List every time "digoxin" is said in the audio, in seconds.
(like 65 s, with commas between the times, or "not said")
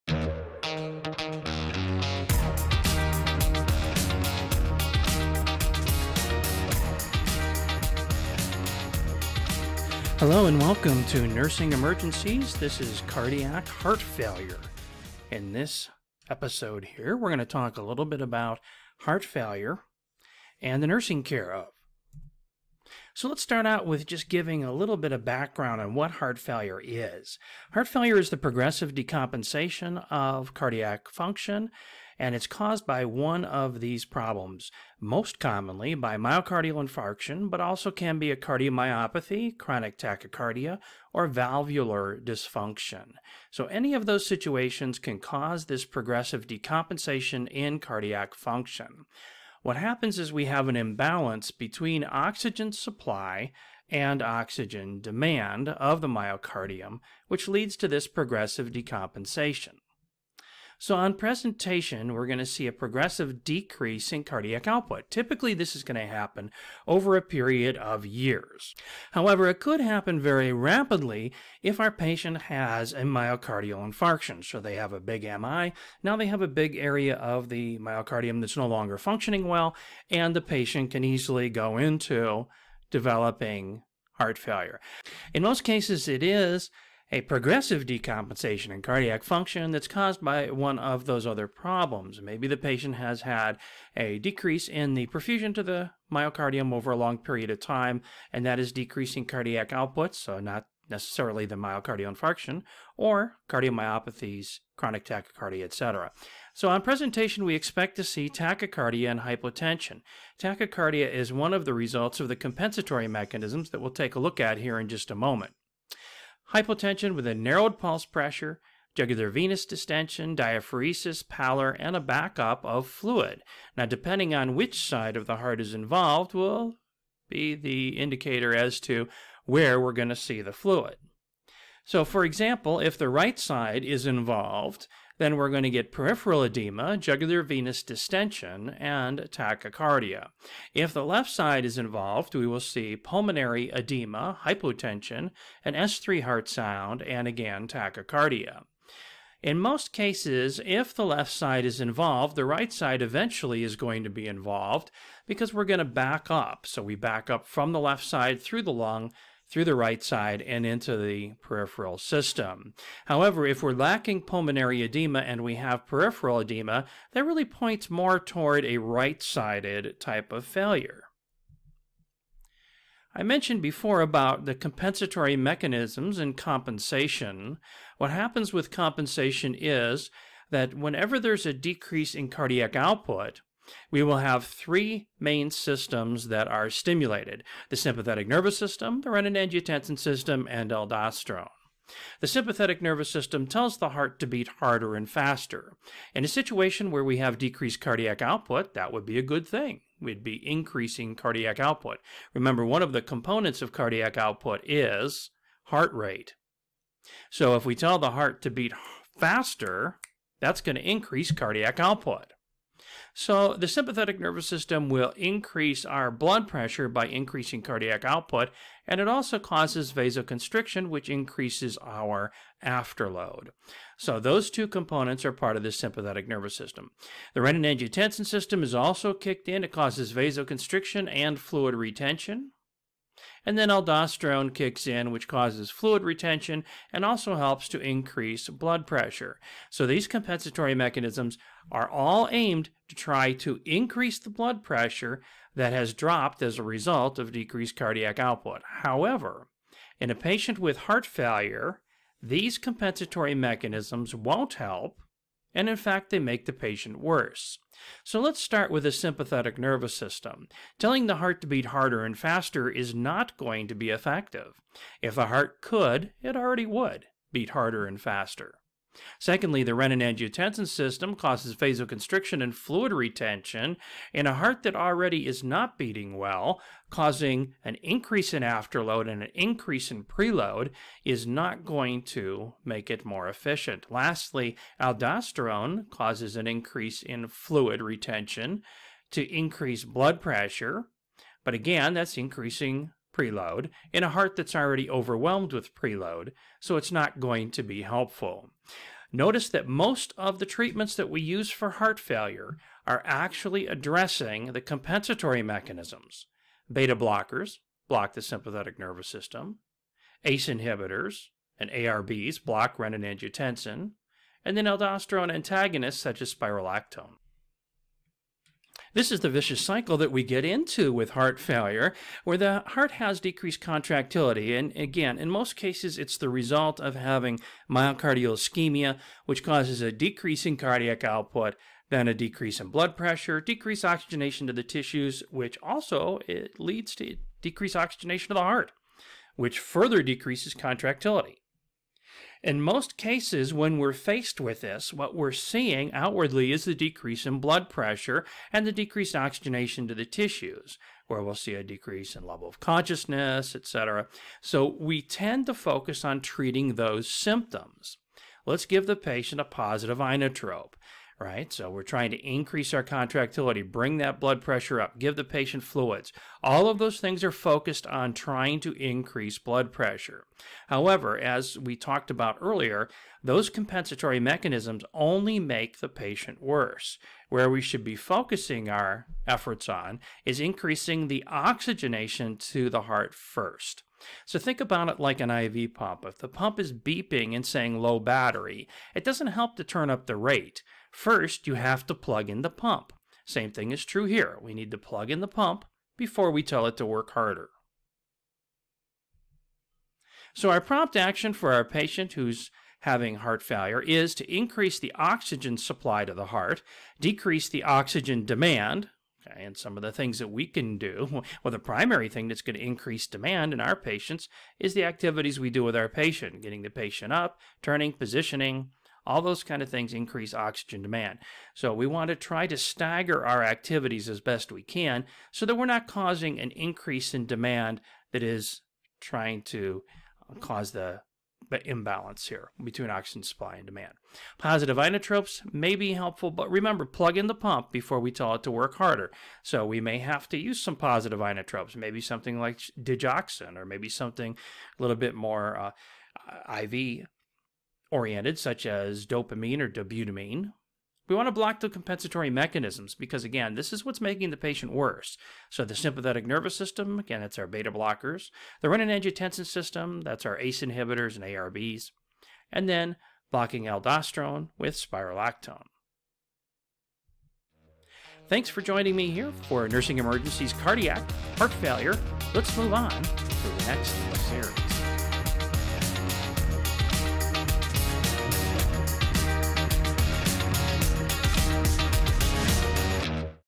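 442 s.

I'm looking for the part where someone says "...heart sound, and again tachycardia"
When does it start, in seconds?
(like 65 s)
146 s.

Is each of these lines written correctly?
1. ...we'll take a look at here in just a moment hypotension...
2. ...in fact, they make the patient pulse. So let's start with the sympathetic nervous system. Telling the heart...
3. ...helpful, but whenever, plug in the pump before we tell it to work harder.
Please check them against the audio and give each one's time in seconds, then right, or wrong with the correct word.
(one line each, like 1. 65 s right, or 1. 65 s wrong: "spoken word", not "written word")
1. 113 s right
2. 255 s wrong: "worse", not "pulse"
3. 435 s wrong: "remember", not "whenever".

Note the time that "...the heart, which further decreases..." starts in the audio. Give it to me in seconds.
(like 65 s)
338 s.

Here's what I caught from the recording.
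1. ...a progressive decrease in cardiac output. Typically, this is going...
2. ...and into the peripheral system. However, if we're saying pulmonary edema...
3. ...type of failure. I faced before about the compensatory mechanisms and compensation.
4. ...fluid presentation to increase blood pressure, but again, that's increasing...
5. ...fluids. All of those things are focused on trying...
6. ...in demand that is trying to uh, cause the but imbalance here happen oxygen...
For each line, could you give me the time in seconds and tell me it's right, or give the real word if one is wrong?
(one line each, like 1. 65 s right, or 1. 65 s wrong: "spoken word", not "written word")
1. 62 s right
2. 160 s wrong: "lacking", not "saying"
3. 169 s wrong: "mentioned", not "faced"
4. 287 s wrong: "retention", not "presentation"
5. 365 s right
6. 427 s wrong: "between", not "happen".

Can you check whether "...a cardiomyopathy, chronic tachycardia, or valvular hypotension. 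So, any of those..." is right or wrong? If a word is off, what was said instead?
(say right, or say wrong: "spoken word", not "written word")
wrong: "dysfunction", not "hypotension".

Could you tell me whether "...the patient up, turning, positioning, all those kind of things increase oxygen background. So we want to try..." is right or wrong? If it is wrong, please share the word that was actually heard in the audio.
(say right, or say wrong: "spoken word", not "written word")
wrong: "demand", not "background".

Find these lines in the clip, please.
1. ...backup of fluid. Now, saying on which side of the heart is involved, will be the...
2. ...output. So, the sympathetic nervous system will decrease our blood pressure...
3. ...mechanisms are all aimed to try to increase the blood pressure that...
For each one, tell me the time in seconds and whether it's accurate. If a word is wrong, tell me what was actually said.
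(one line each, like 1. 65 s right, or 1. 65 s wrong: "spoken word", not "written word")
1. 122 s wrong: "depending", not "saying"
2. 211 s wrong: "increase", not "decrease"
3. 240 s right.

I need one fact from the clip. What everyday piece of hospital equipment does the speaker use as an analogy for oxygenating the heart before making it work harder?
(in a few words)
An IV pump.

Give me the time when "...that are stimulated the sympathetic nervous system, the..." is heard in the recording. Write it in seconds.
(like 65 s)
186 s.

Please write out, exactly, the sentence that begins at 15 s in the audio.
In this episode here, we're going to talk a little bit about heart failure and the nursing care of.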